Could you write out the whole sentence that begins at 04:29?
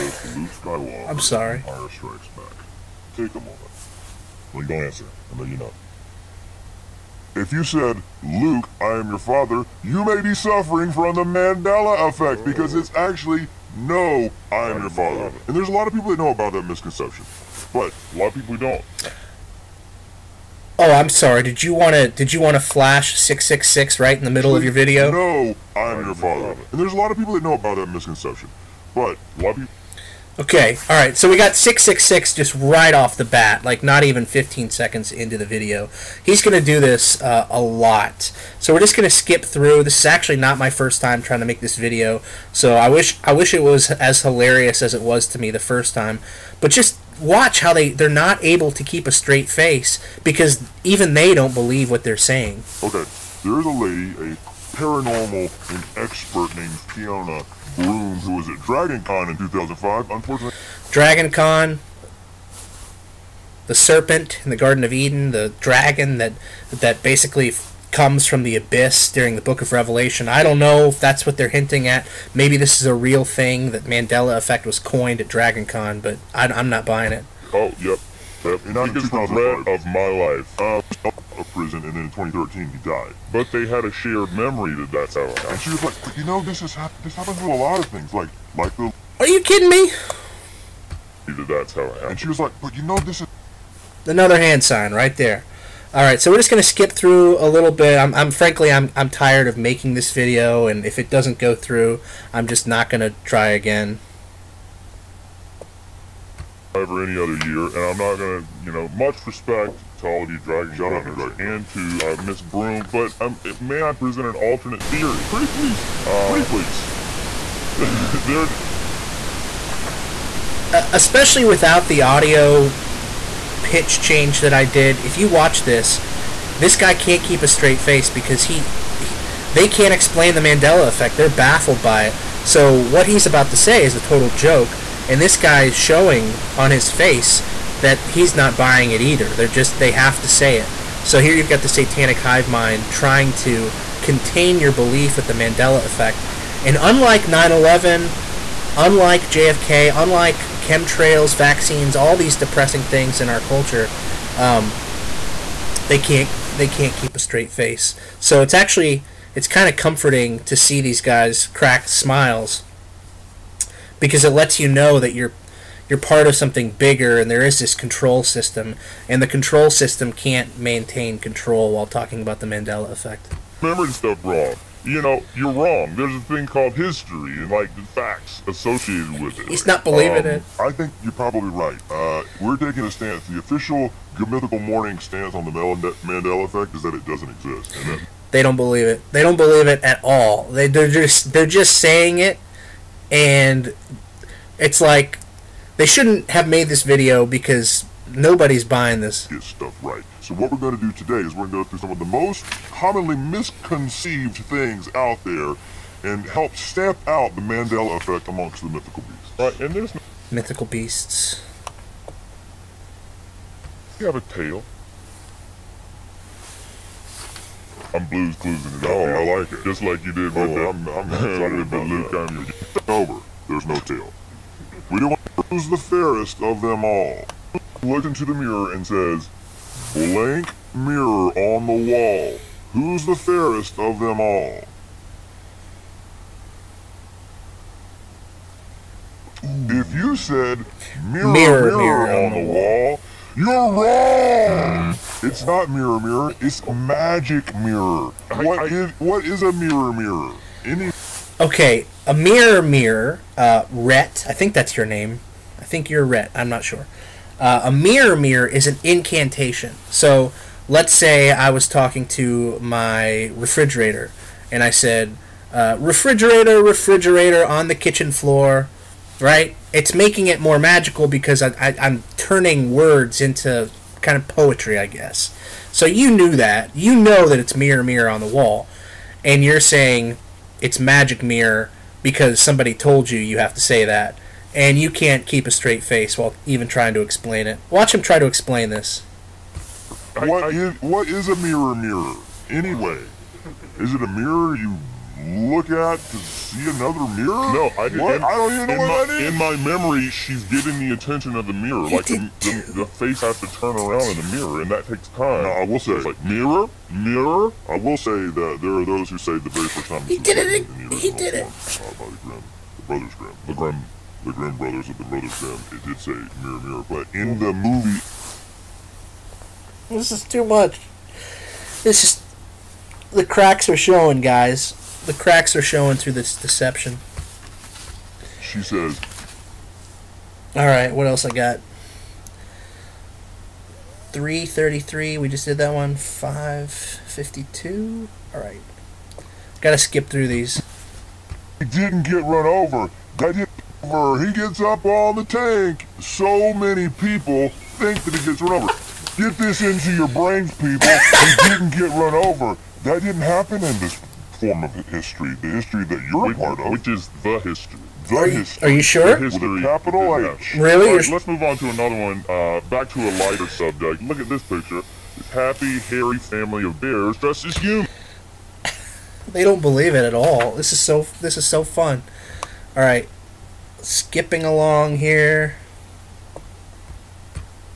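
It's making it more magical because I, I, I'm turning words into kind of poetry, I guess.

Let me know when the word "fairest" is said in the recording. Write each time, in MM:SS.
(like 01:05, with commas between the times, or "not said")
03:45, 03:53.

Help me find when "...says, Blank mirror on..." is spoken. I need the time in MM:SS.
03:48.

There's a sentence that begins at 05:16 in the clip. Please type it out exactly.
But in the movie, this is too much.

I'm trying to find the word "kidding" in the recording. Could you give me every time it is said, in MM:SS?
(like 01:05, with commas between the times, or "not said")
01:29.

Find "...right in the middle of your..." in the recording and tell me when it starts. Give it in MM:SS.
00:23.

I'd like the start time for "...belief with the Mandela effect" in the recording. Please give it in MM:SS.
02:24.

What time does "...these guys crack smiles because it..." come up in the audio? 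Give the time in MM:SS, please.
02:40.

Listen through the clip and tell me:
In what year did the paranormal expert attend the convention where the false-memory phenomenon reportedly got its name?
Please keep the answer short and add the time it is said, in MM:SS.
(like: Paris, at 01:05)
2005, at 00:59.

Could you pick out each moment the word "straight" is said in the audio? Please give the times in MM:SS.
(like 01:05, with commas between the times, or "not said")
00:49, 02:07, 02:37, 04:45.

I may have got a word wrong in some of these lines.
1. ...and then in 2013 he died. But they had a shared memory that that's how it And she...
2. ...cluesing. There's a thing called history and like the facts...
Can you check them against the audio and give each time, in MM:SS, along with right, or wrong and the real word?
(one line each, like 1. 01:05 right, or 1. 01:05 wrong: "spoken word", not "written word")
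1. 01:21 right
2. 02:55 wrong: "wrong", not "cluesing".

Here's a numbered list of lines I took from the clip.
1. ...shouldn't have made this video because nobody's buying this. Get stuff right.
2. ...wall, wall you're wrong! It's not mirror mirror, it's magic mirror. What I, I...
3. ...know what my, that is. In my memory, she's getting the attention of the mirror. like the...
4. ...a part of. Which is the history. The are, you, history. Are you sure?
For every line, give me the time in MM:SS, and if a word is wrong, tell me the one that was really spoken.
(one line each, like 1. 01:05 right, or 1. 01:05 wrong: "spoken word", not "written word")
1. 03:15 right
2. 04:02 right
3. 04:58 right
4. 05:56 right.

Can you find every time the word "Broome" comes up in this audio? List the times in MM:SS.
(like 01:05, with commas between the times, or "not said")
00:57, 01:52.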